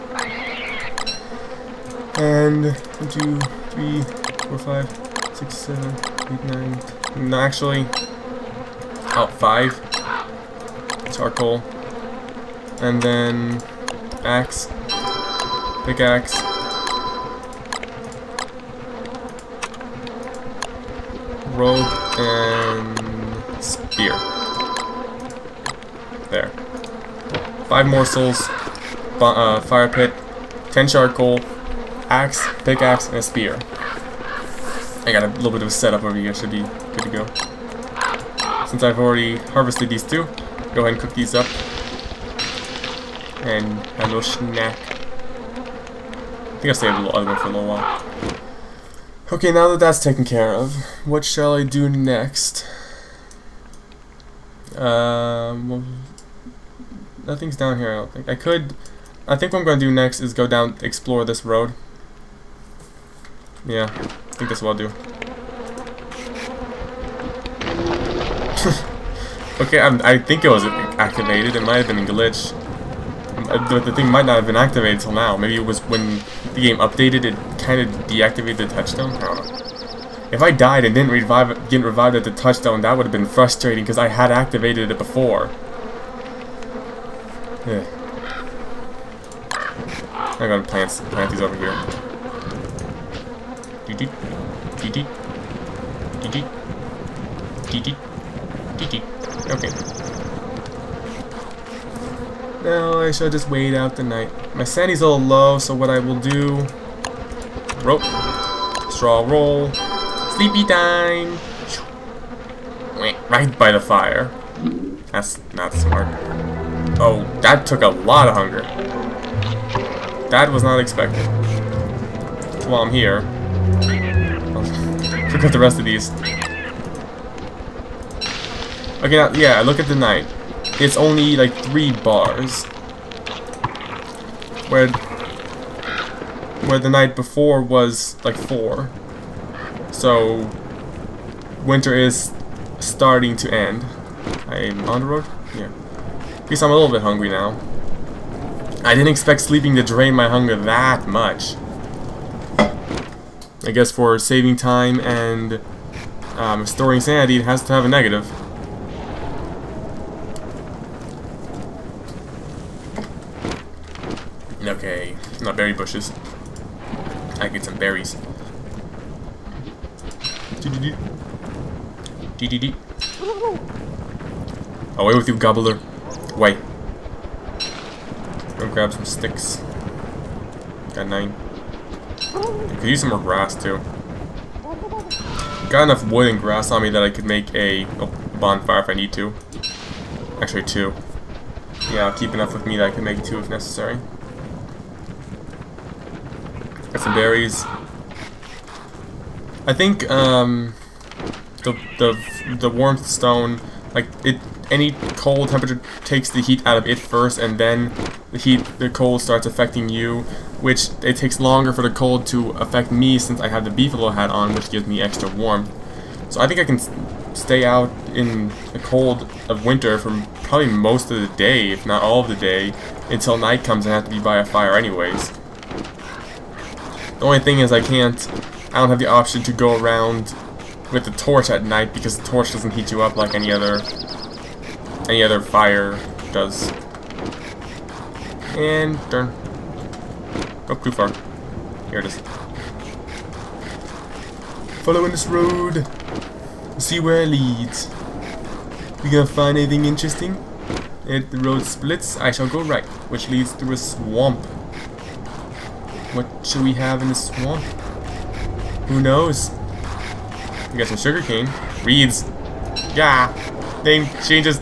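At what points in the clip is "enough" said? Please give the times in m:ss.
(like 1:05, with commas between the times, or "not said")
3:05, 3:12.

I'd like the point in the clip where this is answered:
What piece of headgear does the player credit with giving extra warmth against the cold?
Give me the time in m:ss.
3:33.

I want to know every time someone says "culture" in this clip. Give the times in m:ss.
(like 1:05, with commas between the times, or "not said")
not said.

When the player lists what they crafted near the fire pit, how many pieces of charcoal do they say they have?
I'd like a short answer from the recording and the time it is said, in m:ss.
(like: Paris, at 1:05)
10, at 0:30.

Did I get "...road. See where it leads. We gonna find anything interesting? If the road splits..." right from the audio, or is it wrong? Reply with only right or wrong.
right.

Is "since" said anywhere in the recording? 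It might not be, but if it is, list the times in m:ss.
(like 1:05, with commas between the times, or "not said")
0:38, 3:33.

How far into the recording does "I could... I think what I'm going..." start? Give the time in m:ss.
0:58.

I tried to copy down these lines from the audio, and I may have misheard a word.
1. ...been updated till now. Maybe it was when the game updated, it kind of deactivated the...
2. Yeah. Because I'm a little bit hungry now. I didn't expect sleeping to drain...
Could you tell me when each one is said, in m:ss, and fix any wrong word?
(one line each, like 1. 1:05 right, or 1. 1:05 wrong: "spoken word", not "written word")
1. 1:14 wrong: "activated", not "updated"
2. 2:25 right.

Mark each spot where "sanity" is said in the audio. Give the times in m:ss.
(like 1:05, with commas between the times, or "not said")
1:44, 2:37.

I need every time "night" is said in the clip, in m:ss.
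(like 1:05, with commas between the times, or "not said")
1:44, 2:09, 2:16, 3:43, 3:51.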